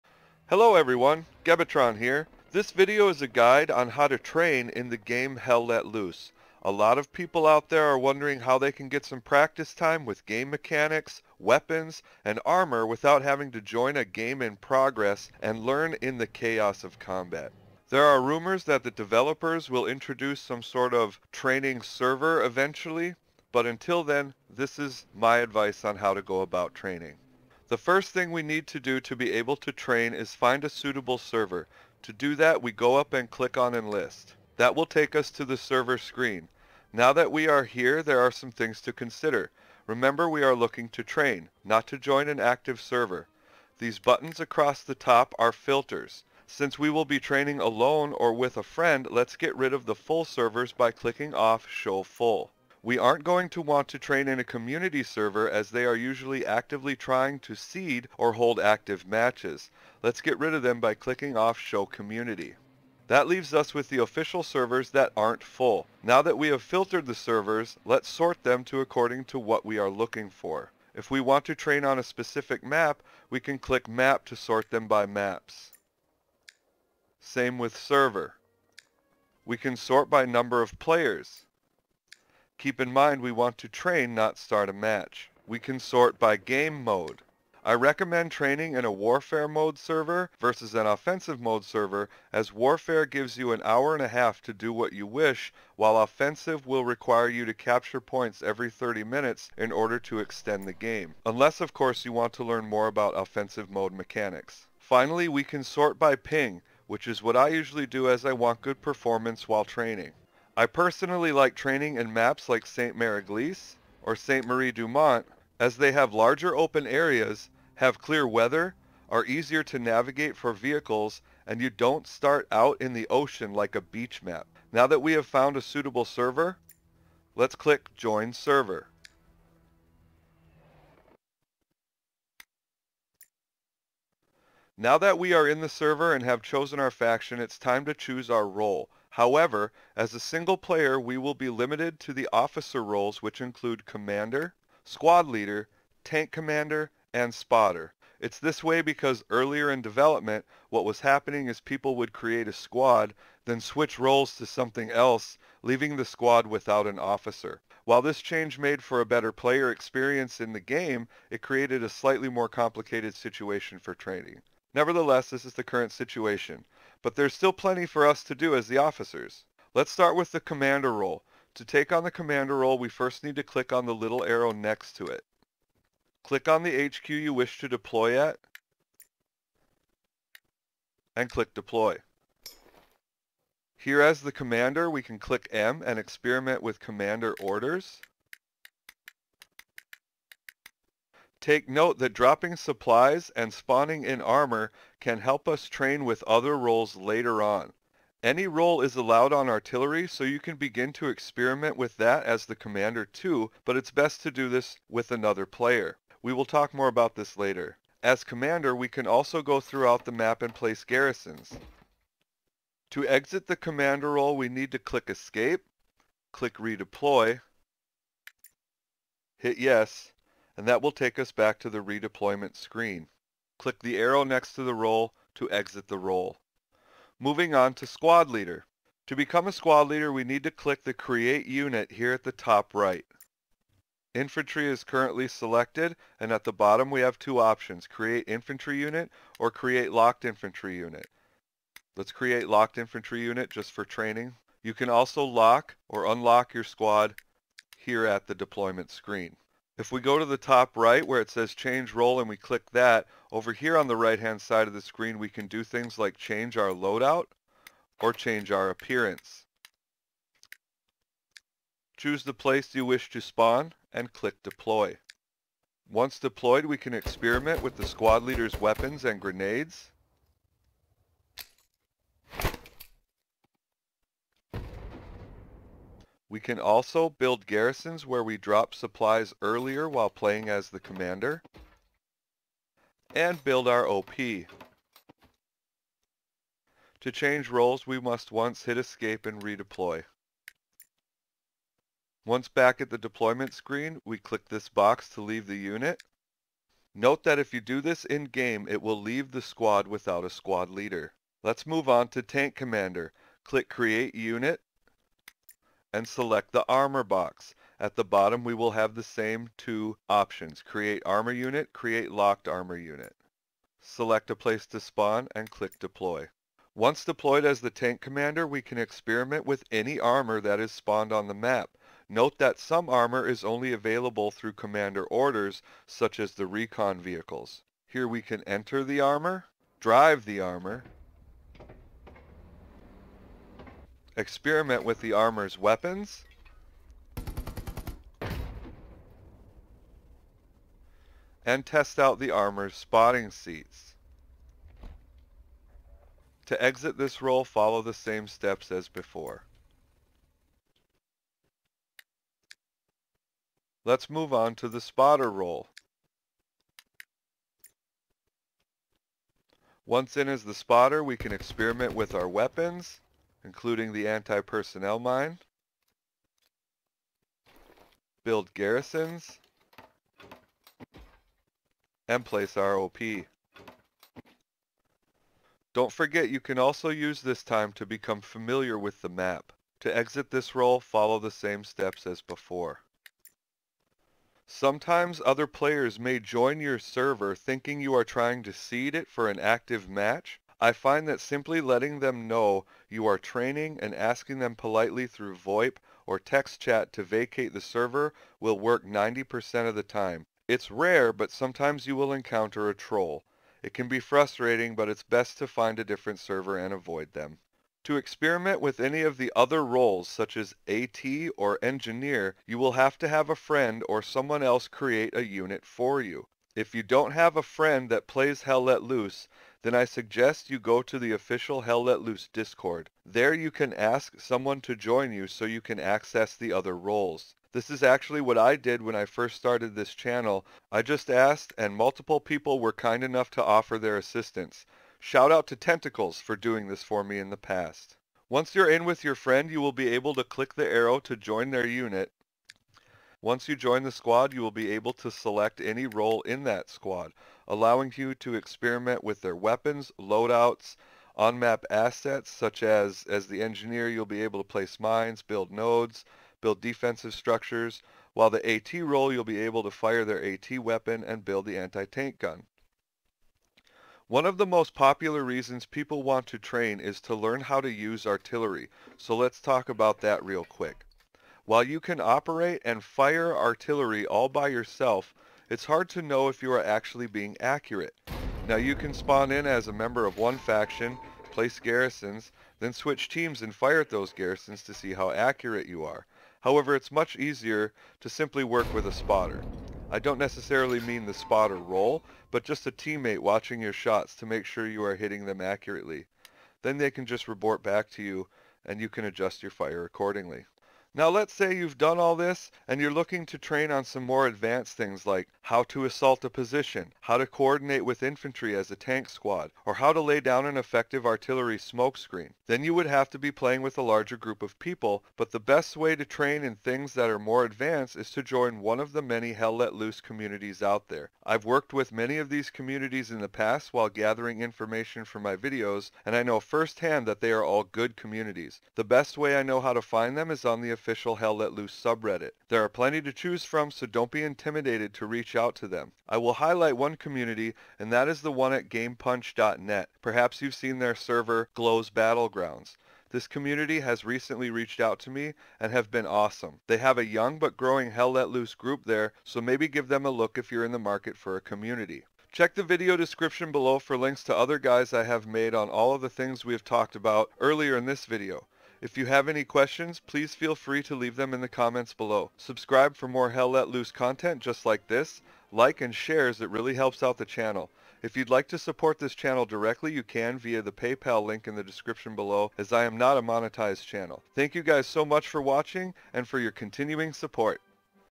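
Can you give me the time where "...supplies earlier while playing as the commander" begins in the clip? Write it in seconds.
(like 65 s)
278 s.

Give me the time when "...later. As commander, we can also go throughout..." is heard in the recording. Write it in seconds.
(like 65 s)
207 s.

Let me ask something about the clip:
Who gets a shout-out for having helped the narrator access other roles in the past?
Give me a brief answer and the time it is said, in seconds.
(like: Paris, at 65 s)
Tentacles, at 435 s.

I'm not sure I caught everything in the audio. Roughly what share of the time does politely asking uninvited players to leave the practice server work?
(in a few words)
90%.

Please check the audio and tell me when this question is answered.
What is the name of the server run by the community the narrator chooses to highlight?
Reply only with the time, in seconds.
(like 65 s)
541 s.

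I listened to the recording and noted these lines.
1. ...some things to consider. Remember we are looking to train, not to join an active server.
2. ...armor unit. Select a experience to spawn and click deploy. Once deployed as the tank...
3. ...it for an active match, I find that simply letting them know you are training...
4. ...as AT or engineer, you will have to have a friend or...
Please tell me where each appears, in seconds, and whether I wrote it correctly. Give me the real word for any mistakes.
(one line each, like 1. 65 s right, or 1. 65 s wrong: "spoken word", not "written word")
1. 38 s right
2. 312 s wrong: "place", not "experience"
3. 388 s right
4. 410 s right.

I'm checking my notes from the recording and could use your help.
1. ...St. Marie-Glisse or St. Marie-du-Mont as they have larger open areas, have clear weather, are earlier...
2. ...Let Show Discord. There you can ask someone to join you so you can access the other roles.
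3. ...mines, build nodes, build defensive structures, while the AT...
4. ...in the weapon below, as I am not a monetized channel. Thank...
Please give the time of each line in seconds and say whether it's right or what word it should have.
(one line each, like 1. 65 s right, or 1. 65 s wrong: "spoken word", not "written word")
1. 112 s wrong: "easier", not "earlier"
2. 421 s wrong: "Loose", not "Show"
3. 454 s right
4. 571 s wrong: "description", not "weapon".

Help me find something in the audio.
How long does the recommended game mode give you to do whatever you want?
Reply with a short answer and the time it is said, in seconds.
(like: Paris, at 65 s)
an hour and a half, at 93 s.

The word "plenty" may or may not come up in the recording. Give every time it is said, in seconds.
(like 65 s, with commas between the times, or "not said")
167 s, 532 s.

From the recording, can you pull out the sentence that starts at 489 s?
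I don't necessarily mean the spotter role, but just a teammate watching your shots to make sure you are hitting them accurately.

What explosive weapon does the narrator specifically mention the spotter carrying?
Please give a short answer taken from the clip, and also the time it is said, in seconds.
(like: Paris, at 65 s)
anti-personnel mine, at 364 s.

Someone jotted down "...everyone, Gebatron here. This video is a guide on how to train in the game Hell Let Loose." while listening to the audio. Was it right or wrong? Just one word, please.
right.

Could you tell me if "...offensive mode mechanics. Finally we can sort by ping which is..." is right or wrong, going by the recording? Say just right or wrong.
right.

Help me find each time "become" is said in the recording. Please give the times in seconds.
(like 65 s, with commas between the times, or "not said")
229 s, 377 s.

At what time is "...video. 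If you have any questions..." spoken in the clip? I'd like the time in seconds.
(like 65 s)
558 s.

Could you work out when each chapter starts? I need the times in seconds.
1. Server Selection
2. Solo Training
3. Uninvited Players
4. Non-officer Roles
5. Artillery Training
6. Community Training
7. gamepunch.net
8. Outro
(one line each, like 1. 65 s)
1. 27 s
2. 134 s
3. 384 s
4. 408 s
5. 463 s
6. 501 s
7. 536 s
8. 552 s.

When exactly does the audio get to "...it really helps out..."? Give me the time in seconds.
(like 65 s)
566 s.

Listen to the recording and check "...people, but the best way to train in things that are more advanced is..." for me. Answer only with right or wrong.
right.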